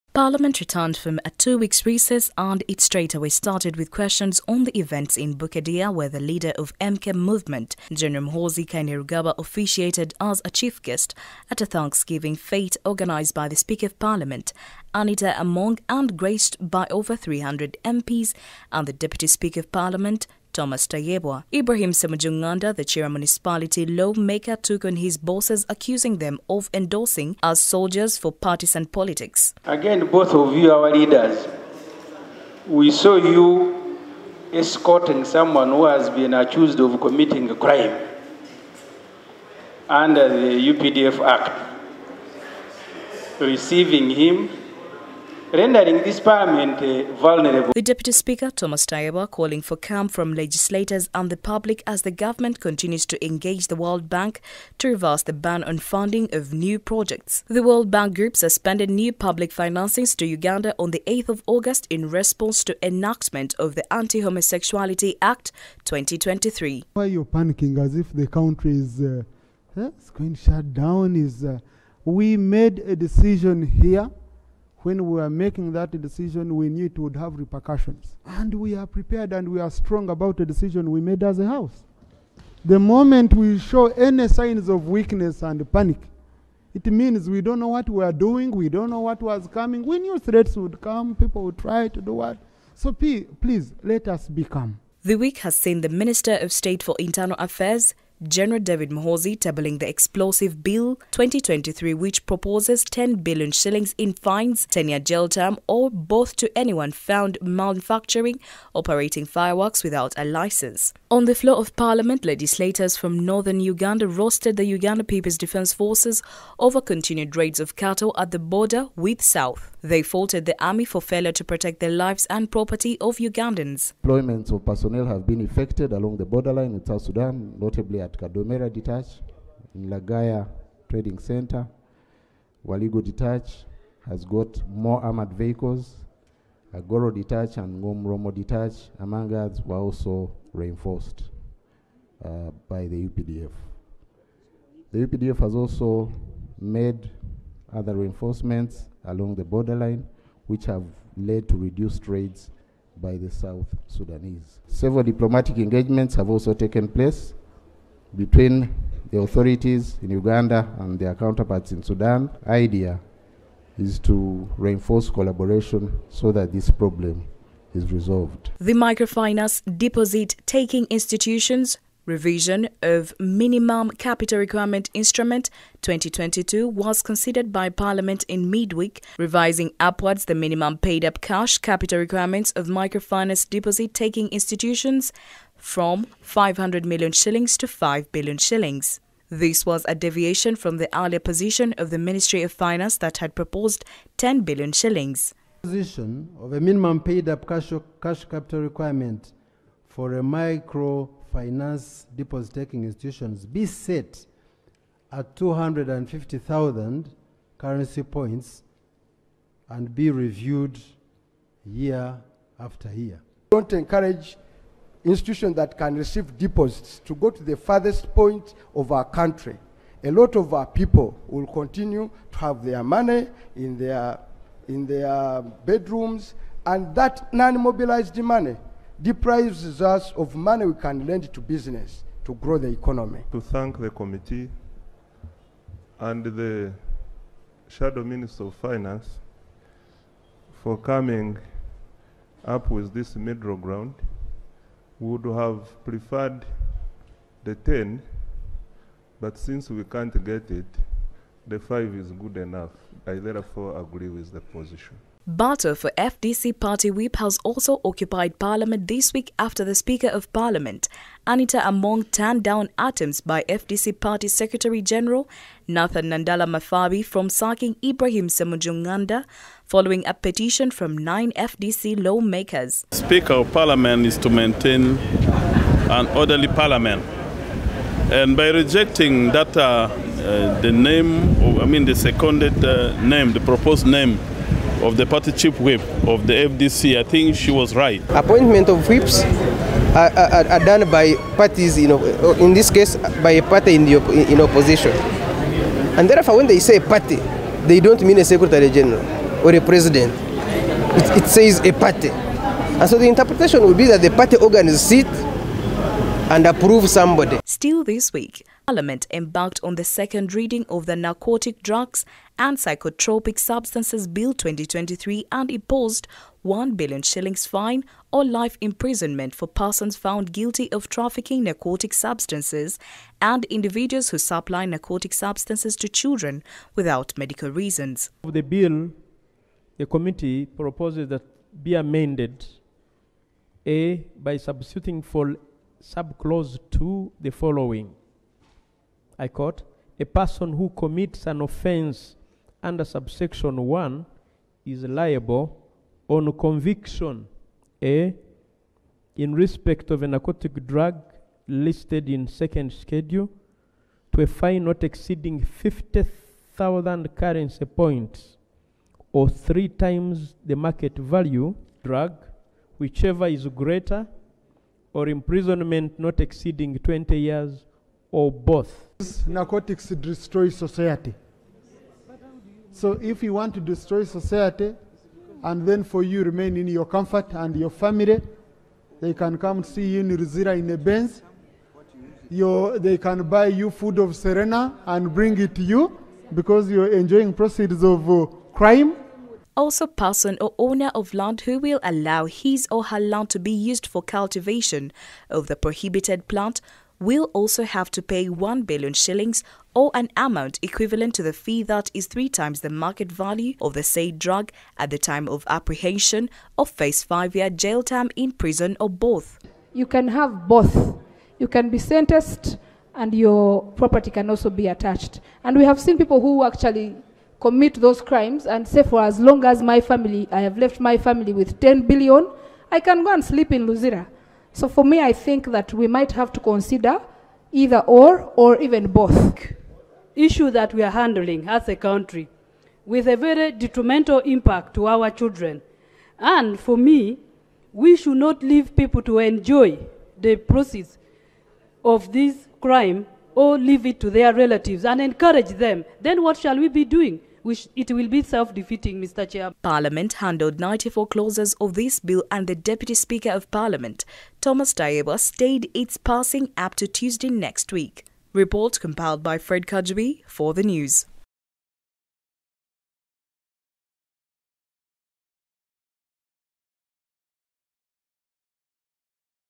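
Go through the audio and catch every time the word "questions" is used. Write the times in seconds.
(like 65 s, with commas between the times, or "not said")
3 s.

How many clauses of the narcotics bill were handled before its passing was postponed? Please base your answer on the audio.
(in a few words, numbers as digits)
94.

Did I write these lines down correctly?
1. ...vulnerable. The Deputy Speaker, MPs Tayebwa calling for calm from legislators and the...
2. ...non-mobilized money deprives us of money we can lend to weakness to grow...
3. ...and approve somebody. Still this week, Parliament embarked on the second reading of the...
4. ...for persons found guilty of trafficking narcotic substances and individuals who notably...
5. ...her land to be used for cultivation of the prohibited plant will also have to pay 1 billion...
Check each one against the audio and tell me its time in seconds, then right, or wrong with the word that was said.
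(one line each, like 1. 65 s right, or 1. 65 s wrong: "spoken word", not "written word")
1. 47 s wrong: "Thomas", not "MPs"
2. 227 s wrong: "business", not "weakness"
3. 306 s right
4. 319 s wrong: "supply", not "notably"
5. 392 s right.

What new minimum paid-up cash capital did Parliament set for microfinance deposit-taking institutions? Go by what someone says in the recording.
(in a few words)
5 billion shillings.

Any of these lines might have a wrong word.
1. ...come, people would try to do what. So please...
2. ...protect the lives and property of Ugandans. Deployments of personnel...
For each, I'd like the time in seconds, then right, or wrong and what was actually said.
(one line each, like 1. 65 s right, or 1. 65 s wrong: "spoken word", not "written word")
1. 90 s right
2. 121 s right.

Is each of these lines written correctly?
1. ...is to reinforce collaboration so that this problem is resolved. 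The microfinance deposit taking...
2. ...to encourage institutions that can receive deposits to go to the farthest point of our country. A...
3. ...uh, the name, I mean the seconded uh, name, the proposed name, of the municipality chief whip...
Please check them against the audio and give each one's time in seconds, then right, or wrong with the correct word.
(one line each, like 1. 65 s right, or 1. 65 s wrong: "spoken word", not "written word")
1. 163 s right
2. 213 s right
3. 280 s wrong: "party", not "municipality".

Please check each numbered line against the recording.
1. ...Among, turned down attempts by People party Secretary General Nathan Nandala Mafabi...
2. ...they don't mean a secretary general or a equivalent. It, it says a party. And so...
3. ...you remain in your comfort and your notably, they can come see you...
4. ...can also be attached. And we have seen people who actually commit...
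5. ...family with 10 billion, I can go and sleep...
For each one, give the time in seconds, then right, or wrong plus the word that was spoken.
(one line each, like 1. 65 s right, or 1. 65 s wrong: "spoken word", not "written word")
1. 261 s wrong: "FDC", not "People"
2. 297 s wrong: "president", not "equivalent"
3. 376 s wrong: "family", not "notably"
4. 414 s right
5. 420 s right.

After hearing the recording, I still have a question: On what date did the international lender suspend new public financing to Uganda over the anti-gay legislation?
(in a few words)
8th of August.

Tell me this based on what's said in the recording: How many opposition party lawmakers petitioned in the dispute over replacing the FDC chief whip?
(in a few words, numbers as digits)
9.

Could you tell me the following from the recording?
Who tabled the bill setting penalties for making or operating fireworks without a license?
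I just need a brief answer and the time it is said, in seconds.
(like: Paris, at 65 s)
General David Muhoozi, at 98 s.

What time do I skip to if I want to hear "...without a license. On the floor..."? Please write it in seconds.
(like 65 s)
109 s.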